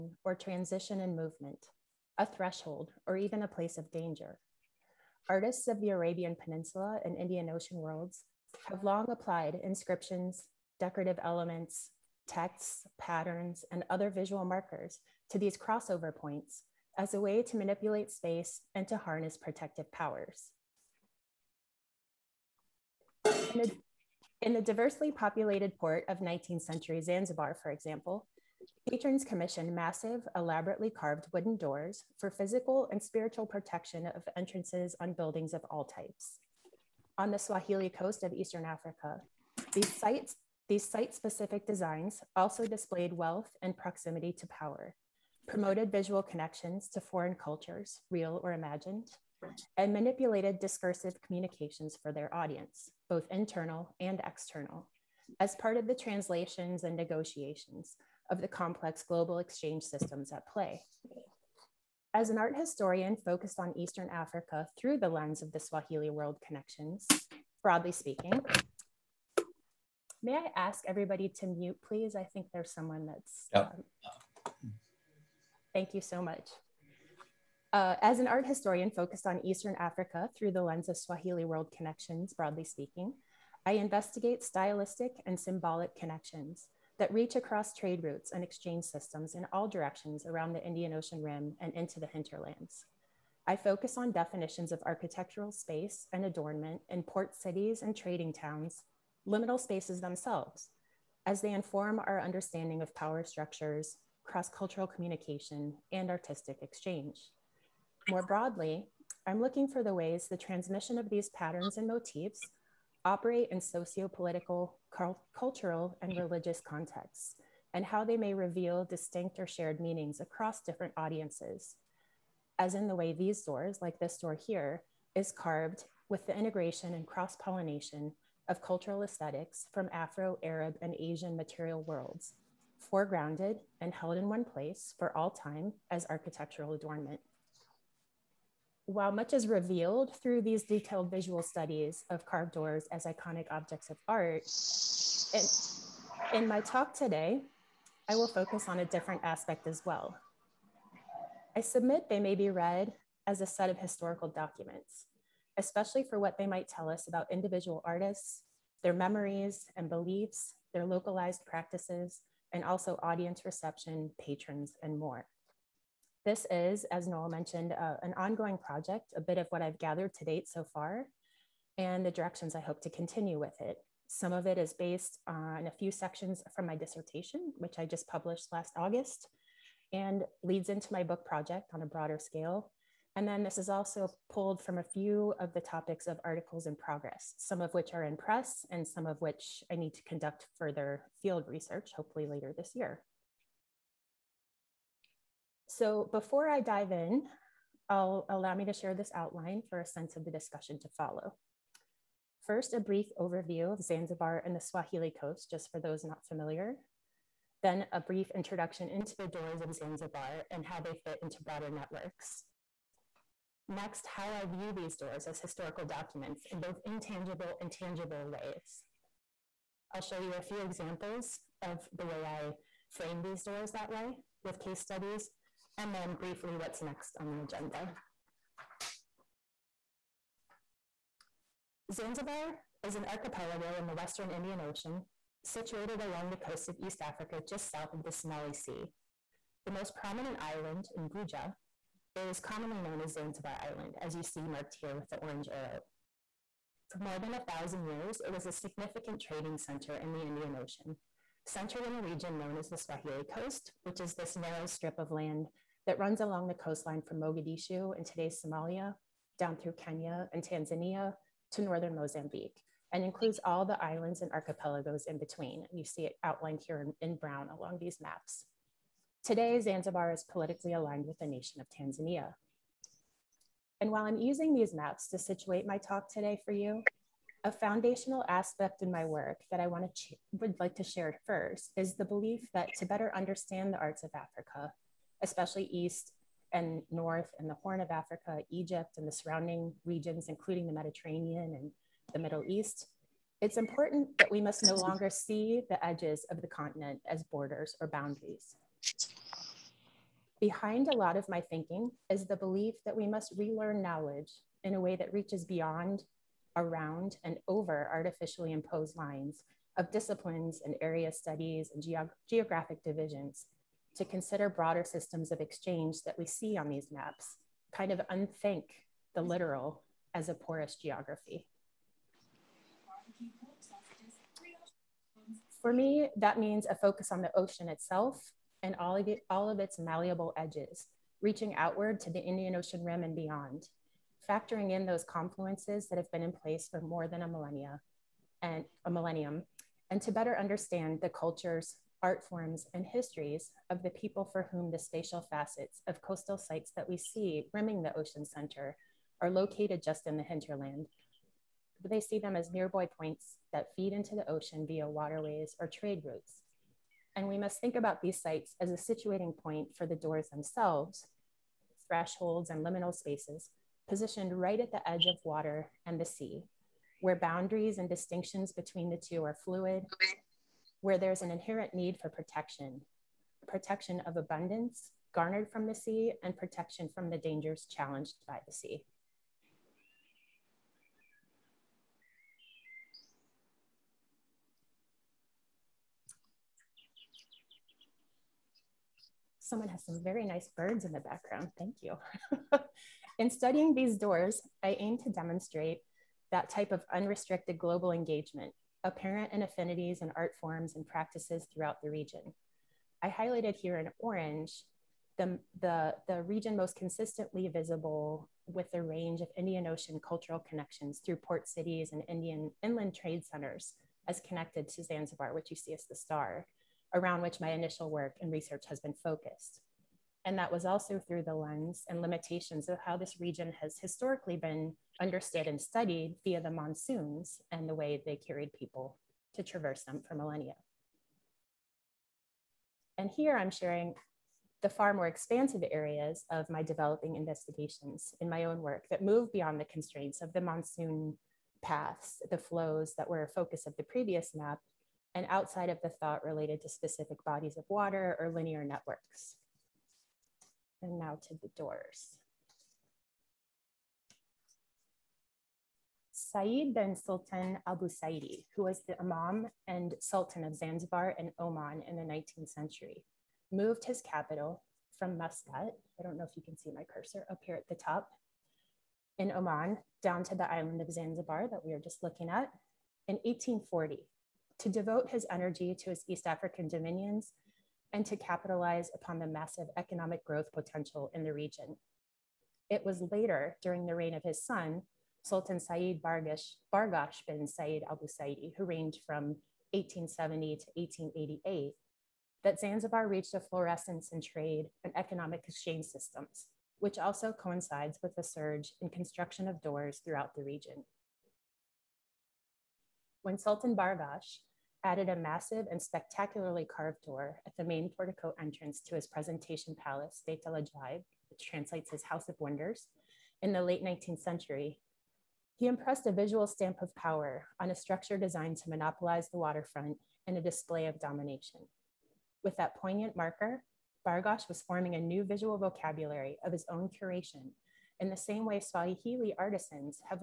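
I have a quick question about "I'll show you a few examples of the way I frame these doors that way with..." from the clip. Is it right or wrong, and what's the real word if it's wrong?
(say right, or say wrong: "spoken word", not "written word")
right.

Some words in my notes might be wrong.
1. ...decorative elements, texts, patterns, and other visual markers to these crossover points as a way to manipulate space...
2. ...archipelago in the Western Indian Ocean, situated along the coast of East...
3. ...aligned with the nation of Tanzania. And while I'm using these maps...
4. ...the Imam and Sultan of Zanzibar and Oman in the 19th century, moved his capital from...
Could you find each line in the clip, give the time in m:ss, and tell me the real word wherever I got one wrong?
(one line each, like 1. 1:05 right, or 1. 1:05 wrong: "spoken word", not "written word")
1. 0:10 right
2. 3:53 right
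3. 4:30 right
4. 7:38 right.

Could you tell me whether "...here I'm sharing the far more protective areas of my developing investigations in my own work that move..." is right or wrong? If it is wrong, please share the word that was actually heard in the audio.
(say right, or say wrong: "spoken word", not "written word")
wrong: "expansive", not "protective".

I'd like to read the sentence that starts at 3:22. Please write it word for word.
First, a brief overview of Zanzibar and the Swahili coast, just for those not familiar.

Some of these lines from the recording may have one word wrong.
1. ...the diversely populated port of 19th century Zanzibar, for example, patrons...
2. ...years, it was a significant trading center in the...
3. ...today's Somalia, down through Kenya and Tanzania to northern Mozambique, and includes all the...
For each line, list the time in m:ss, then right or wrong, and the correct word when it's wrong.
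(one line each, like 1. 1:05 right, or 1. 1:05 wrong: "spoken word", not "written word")
1. 0:24 right
2. 4:07 right
3. 4:18 right.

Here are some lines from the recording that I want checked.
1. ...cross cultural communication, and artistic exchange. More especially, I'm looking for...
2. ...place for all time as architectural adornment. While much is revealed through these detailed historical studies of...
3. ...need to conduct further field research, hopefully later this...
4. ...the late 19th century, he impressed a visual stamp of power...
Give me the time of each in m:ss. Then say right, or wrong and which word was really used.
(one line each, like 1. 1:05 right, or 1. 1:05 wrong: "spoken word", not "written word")
1. 1:44 wrong: "broadly", not "especially"
2. 2:14 wrong: "visual", not "historical"
3. 3:09 right
4. 8:33 right.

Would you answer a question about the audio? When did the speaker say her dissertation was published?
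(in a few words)
last August.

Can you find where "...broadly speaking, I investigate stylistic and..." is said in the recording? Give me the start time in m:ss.
1:22.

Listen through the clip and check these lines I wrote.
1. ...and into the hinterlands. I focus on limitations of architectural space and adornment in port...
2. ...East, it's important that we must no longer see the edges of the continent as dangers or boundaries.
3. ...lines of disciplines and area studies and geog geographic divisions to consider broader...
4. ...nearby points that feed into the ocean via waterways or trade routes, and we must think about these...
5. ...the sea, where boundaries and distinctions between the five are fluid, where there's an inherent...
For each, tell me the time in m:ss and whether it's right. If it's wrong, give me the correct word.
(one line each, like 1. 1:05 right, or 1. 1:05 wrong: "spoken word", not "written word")
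1. 1:31 wrong: "definitions", not "limitations"
2. 4:52 wrong: "borders", not "dangers"
3. 5:08 right
4. 5:52 right
5. 6:05 wrong: "two", not "five".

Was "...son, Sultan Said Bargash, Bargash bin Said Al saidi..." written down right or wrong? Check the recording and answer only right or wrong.
right.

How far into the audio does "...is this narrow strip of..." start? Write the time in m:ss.
4:13.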